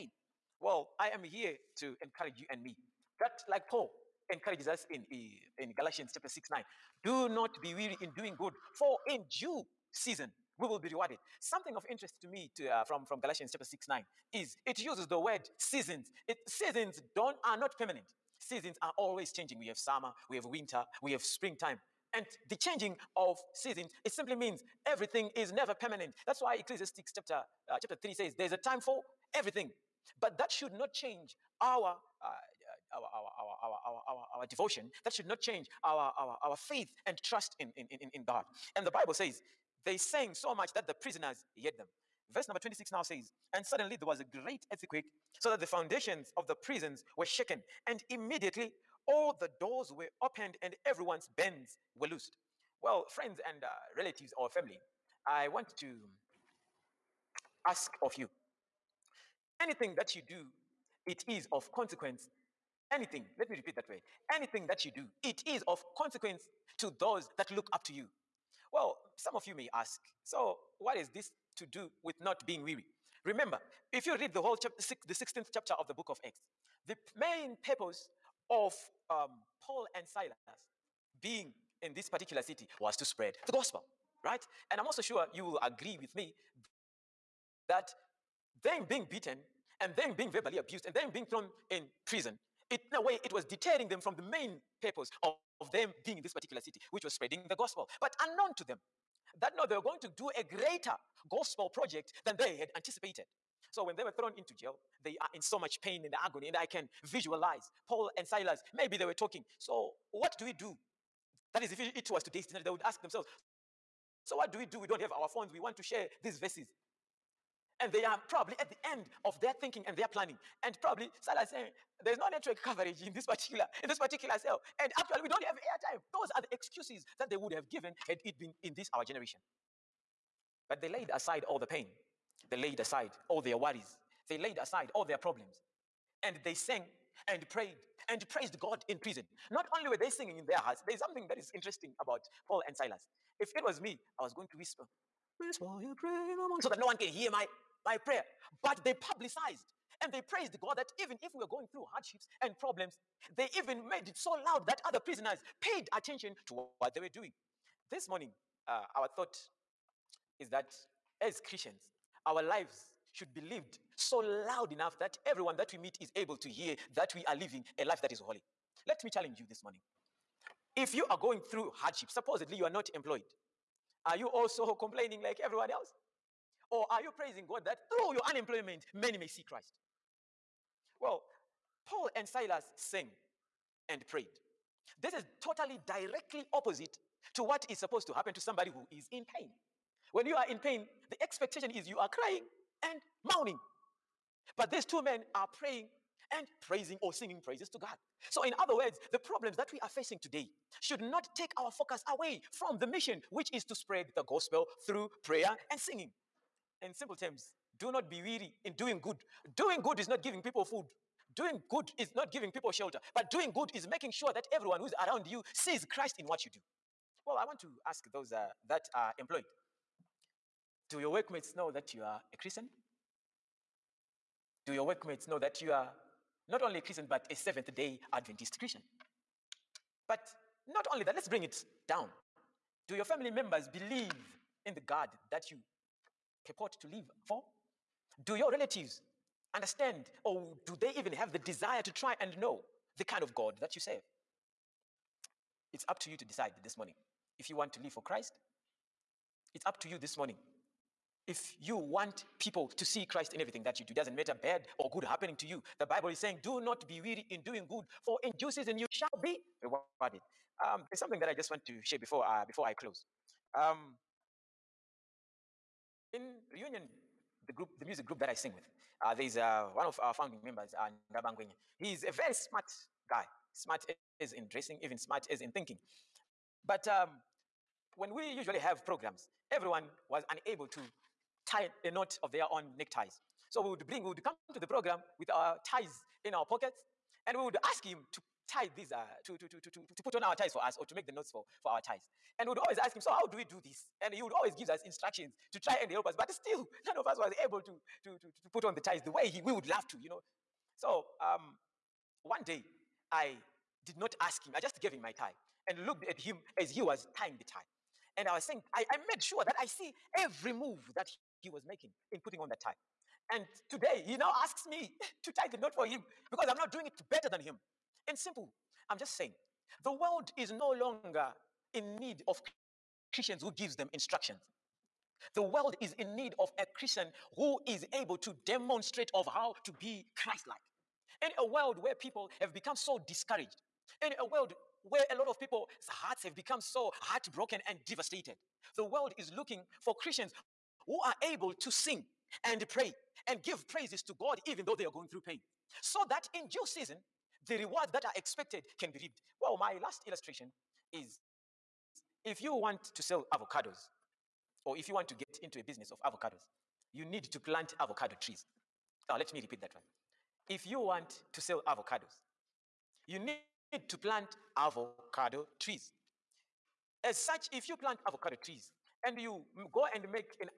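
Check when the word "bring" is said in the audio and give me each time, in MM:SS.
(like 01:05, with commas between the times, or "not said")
03:51, 04:43.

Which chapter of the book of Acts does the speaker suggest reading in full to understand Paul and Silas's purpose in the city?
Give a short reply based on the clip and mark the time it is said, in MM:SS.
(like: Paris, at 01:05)
16th chapter, at 01:15.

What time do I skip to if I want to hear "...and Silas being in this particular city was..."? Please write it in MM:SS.
01:19.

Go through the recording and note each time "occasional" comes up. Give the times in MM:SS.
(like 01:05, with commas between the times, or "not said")
not said.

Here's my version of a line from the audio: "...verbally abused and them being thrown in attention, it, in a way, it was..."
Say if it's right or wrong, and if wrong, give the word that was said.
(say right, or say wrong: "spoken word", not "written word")
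wrong: "prison", not "attention".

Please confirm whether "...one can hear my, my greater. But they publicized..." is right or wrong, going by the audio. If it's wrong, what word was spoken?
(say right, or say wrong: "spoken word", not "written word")
wrong: "prayer", not "greater".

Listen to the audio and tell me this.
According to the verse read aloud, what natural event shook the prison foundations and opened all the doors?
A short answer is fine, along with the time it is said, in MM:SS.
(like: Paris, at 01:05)
A great earthquake, at 00:44.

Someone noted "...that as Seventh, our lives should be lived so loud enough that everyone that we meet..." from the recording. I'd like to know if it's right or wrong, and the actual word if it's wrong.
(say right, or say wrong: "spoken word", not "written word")
wrong: "Christians", not "Seventh".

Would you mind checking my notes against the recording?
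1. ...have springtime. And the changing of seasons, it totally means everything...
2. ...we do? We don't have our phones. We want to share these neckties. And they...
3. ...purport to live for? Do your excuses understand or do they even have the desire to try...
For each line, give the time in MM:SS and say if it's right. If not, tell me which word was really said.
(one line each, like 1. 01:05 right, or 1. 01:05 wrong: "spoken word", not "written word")
1. 00:21 wrong: "simply", not "totally"
2. 01:54 wrong: "verses", not "neckties"
3. 03:56 wrong: "relatives", not "excuses".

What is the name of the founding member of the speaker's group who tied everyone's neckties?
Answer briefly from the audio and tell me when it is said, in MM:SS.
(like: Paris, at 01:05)
Ndabangwenye, at 04:31.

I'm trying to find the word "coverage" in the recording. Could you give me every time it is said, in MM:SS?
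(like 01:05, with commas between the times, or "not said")
02:02.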